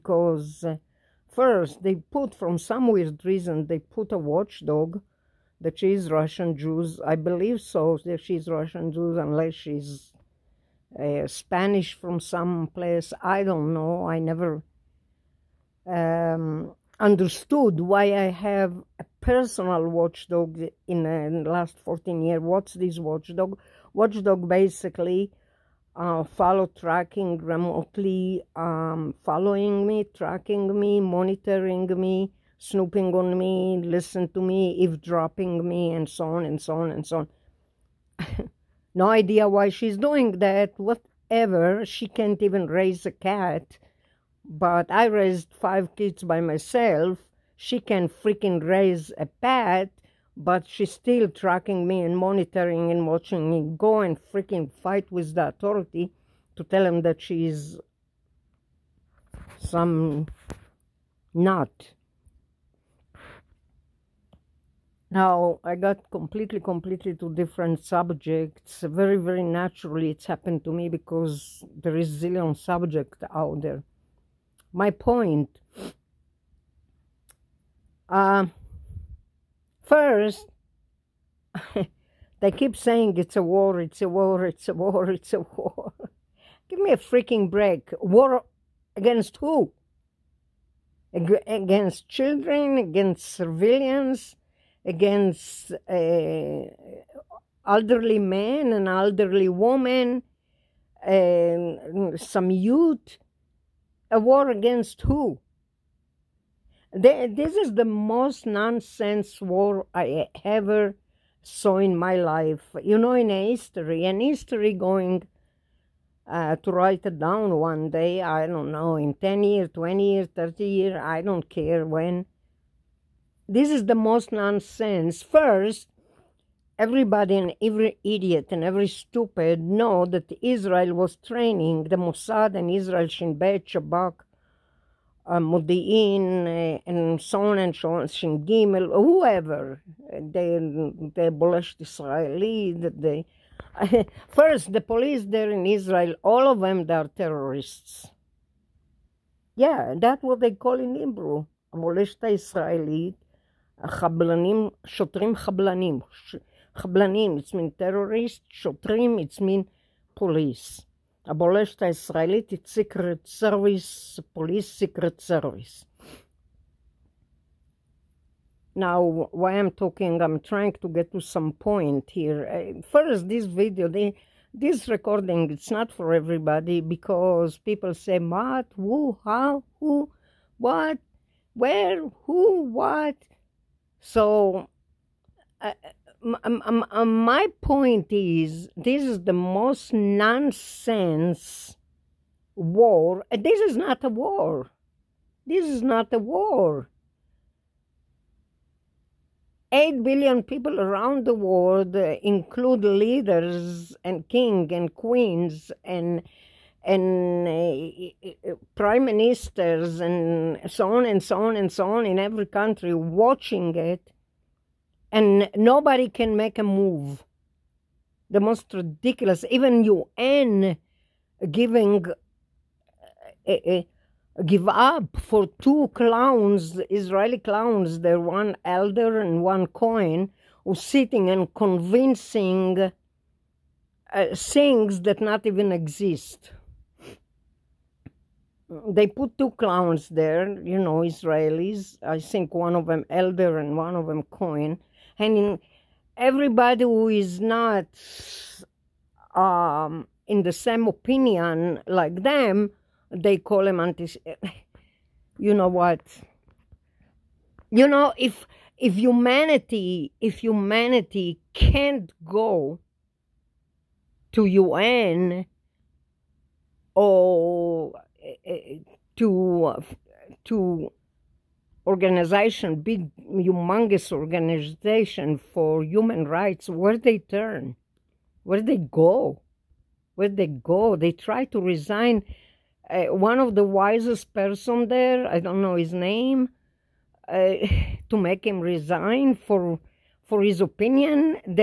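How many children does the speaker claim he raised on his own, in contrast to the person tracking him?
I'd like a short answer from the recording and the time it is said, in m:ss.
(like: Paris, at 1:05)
5, at 0:45.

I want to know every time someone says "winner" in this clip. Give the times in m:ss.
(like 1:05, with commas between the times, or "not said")
not said.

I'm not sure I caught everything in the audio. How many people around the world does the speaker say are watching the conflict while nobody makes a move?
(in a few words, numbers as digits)
8 billion.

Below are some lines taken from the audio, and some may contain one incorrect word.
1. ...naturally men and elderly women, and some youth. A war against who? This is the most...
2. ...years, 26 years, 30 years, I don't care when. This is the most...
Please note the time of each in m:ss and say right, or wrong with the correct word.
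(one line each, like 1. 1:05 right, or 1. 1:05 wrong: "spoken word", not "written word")
1. 1:37 wrong: "elderly", not "naturally"
2. 1:59 wrong: "20", not "26".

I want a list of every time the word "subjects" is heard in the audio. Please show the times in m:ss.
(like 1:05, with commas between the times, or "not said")
1:07, 1:12.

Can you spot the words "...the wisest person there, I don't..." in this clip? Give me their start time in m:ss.
4:43.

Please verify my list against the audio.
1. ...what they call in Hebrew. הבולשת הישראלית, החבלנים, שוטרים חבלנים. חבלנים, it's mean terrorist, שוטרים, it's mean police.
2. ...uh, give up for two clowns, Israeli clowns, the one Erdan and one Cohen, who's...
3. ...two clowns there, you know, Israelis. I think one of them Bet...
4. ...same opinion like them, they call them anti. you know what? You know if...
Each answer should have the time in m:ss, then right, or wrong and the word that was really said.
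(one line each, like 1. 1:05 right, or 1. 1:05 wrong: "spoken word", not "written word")
1. 2:30 right
2. 3:43 right
3. 3:59 wrong: "Erdan", not "Bet"
4. 4:10 right.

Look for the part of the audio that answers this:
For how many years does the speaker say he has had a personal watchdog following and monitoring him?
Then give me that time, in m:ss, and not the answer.
0:21.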